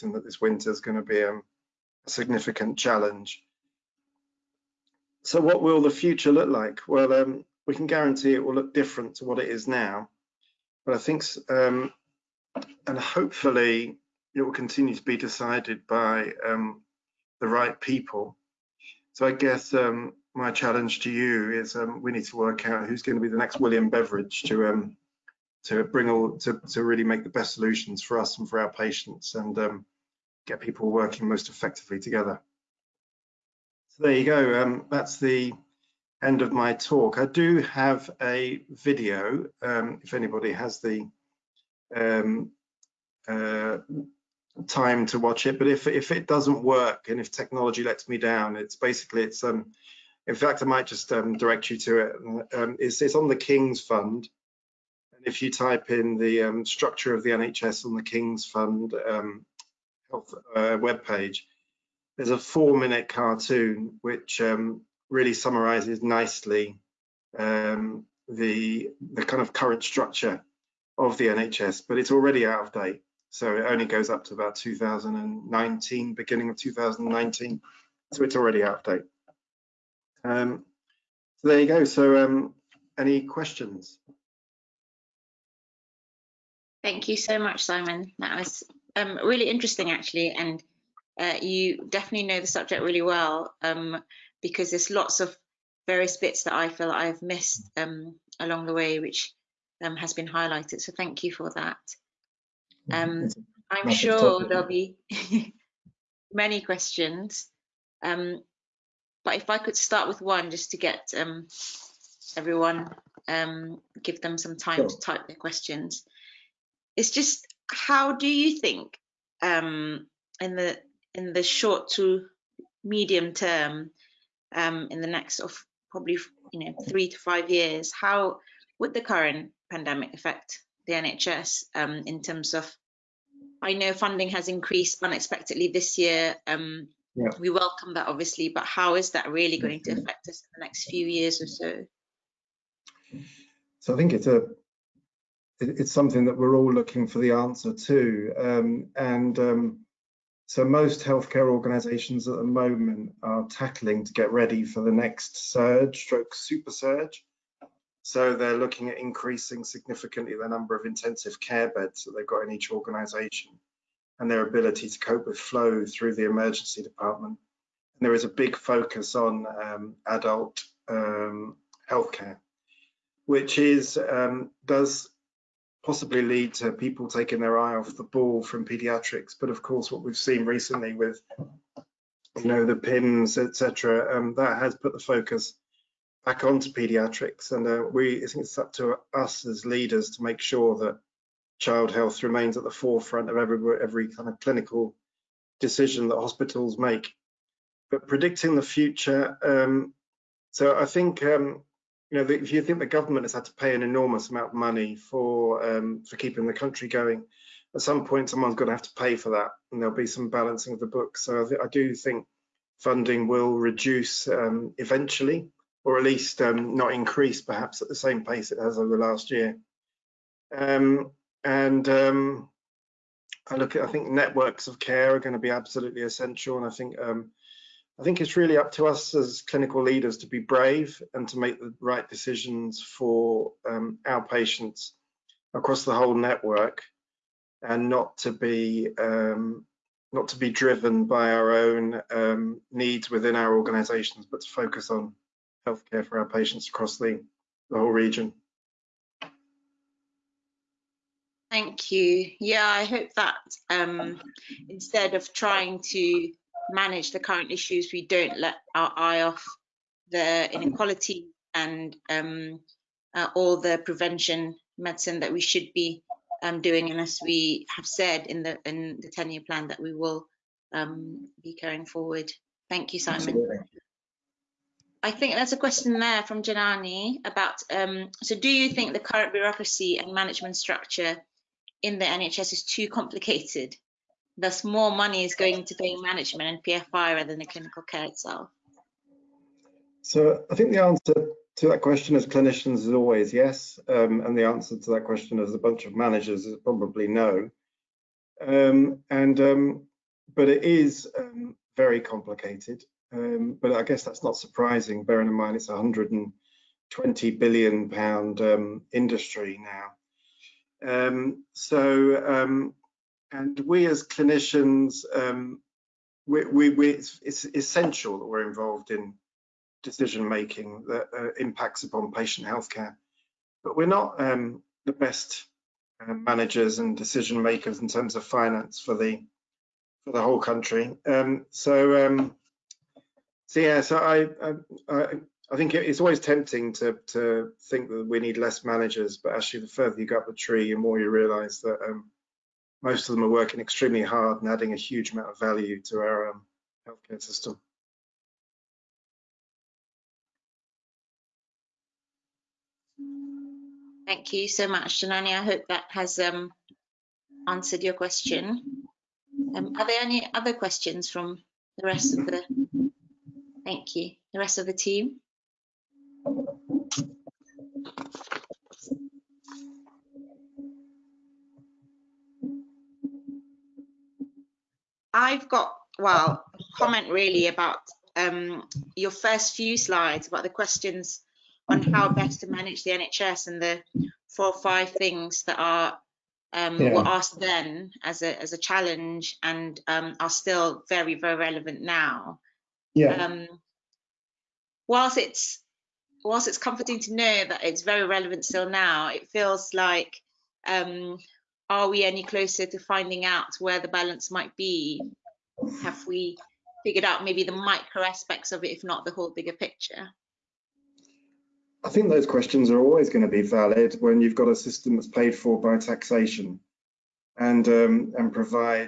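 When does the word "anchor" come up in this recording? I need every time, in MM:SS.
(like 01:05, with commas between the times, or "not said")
not said.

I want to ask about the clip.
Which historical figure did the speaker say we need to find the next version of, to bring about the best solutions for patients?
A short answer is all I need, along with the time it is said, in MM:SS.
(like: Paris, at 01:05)
William Beveridge, at 00:23.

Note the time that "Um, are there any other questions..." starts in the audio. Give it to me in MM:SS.
05:59.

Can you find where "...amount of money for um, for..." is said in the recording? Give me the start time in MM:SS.
03:24.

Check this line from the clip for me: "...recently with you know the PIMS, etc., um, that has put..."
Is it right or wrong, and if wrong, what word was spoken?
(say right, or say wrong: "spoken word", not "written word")
right.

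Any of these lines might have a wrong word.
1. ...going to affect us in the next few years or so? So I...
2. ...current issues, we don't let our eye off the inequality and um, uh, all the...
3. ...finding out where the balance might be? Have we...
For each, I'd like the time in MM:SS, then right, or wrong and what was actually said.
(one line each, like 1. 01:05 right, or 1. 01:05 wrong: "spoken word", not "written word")
1. 02:19 right
2. 04:17 right
3. 06:42 right.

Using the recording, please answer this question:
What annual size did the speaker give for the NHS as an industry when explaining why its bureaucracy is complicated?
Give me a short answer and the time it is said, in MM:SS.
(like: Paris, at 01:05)
120 billion pounds, at 05:05.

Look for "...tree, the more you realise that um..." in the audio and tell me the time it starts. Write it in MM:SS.
05:40.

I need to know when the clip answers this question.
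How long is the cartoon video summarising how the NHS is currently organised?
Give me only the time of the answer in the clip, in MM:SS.
01:02.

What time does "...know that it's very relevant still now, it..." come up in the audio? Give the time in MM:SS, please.
06:37.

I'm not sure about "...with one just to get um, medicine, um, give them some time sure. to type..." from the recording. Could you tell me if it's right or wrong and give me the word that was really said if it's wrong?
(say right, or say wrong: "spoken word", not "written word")
wrong: "everyone", not "medicine".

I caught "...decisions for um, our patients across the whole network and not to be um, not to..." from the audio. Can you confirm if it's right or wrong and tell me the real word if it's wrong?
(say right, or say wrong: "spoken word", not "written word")
right.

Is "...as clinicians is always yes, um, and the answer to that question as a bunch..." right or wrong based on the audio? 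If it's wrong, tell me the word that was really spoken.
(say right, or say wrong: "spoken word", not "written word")
right.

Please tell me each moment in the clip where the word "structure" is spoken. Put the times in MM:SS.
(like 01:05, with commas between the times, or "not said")
00:56, 01:09, 04:40.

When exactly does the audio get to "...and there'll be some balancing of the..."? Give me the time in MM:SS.
03:29.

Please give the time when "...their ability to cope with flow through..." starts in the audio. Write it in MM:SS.
02:44.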